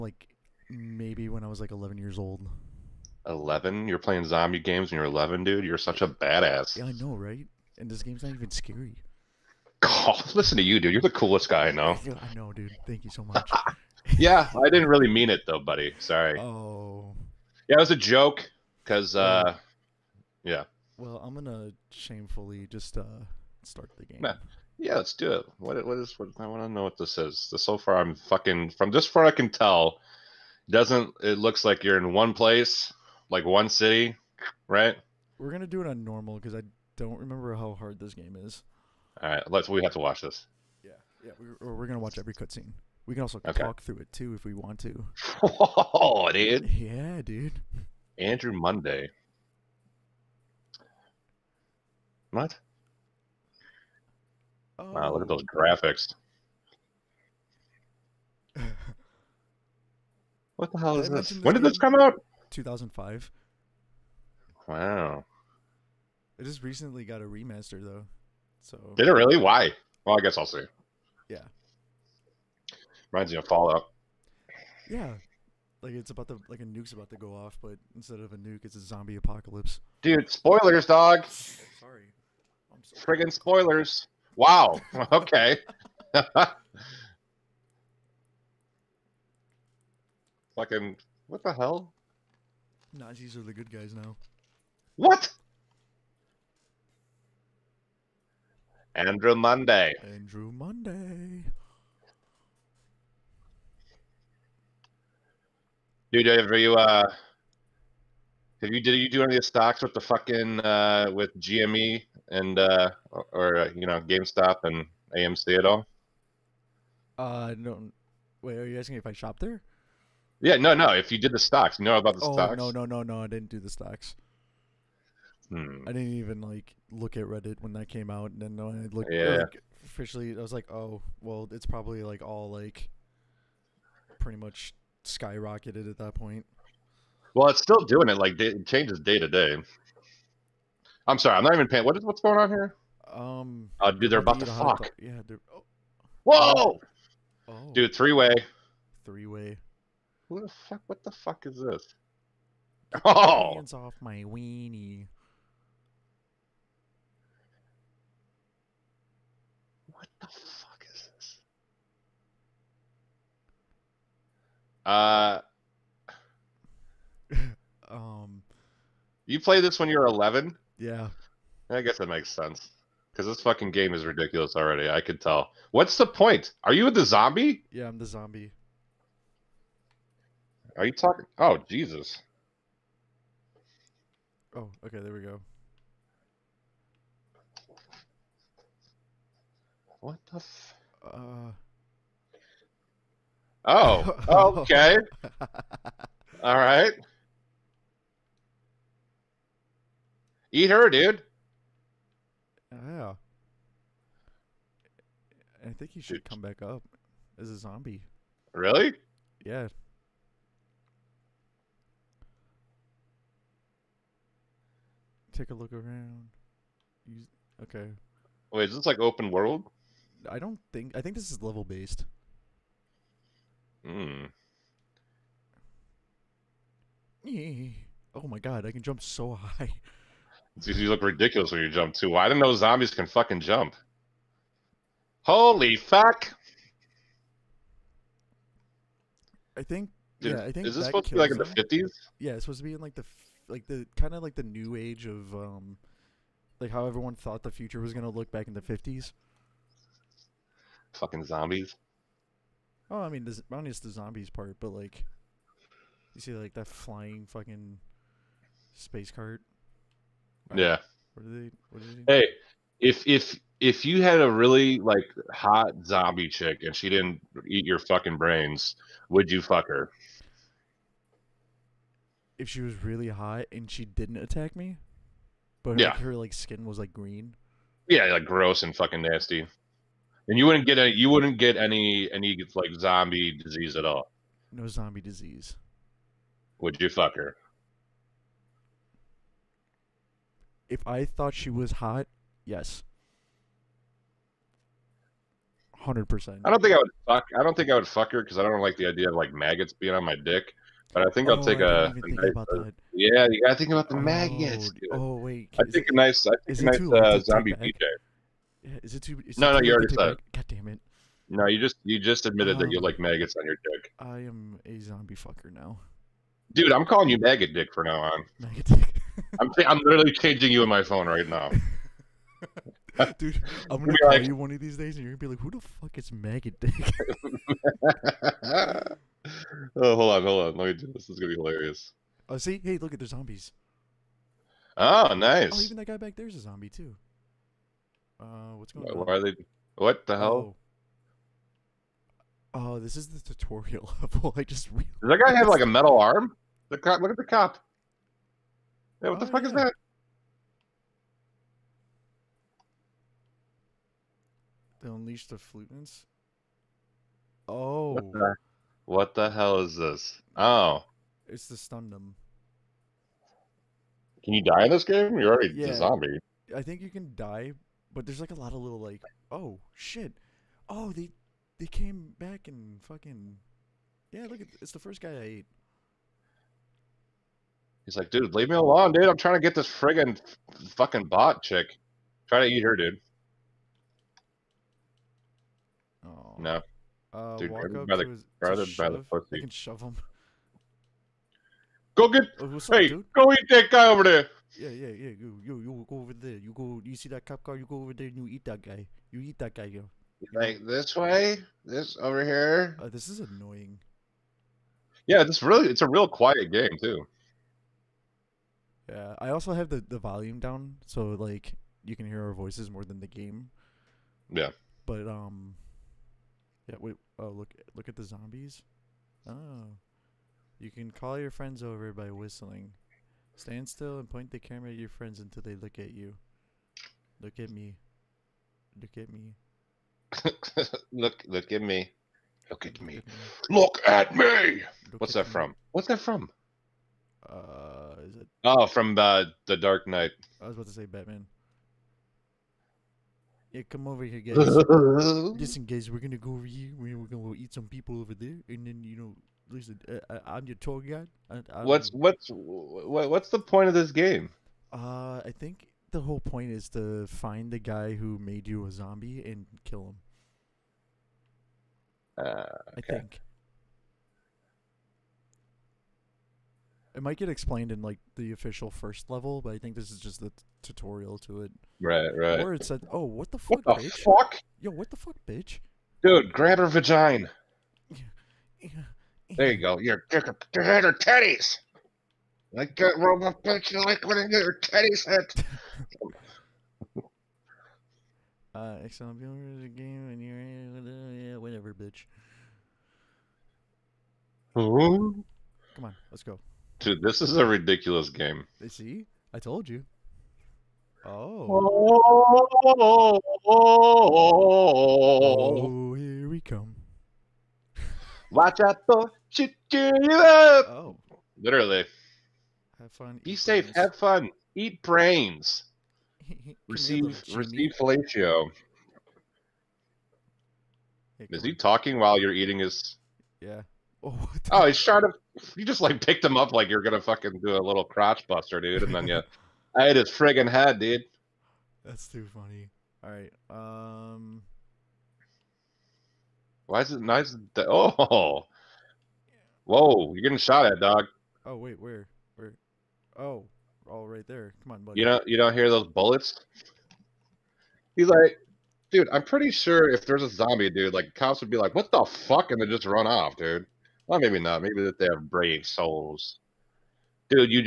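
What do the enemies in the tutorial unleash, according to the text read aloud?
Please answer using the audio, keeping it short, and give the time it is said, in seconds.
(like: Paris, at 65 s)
The flutants, at 355 s.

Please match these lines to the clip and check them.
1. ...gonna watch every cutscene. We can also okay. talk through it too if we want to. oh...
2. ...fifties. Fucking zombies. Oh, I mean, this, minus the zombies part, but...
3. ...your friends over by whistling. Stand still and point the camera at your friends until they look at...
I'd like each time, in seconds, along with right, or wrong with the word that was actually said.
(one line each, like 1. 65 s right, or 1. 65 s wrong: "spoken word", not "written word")
1. 41 s right
2. 248 s right
3. 421 s right.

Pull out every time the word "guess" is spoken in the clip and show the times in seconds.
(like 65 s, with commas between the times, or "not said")
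70 s, 171 s.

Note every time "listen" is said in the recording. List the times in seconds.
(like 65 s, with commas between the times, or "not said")
10 s, 444 s, 449 s.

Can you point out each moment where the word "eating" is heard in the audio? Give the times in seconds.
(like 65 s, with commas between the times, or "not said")
522 s.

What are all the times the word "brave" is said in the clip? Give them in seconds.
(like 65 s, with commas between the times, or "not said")
555 s.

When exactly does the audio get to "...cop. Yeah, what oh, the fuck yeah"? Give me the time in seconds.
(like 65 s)
347 s.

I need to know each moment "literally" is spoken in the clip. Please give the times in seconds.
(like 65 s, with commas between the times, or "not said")
319 s, 511 s.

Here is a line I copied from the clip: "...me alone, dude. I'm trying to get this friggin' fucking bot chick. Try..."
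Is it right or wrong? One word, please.
right.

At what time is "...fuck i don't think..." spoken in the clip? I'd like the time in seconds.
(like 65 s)
297 s.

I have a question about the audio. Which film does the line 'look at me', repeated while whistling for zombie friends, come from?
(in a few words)
The Dark Knight.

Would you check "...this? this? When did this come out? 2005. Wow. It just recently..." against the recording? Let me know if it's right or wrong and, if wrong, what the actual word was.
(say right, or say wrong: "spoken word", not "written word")
right.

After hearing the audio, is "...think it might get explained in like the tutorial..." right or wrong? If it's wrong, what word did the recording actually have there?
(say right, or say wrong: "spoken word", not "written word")
wrong: "official", not "tutorial".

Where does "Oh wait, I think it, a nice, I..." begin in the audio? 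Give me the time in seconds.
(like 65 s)
304 s.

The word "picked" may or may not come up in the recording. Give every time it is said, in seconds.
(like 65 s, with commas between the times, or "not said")
526 s.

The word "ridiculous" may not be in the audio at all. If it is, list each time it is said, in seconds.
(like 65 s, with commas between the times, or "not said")
174 s, 231 s, 497 s.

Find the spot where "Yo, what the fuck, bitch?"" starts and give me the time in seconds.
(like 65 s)
474 s.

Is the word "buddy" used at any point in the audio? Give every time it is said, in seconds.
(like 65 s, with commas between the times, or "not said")
15 s, 544 s.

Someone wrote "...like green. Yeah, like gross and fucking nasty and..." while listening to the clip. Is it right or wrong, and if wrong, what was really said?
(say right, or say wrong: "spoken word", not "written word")
right.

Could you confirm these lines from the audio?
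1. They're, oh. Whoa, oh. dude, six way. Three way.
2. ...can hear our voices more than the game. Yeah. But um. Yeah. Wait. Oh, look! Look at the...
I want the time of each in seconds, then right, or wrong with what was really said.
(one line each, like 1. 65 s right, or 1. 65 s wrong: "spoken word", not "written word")
1. 145 s wrong: "three", not "six"
2. 411 s right.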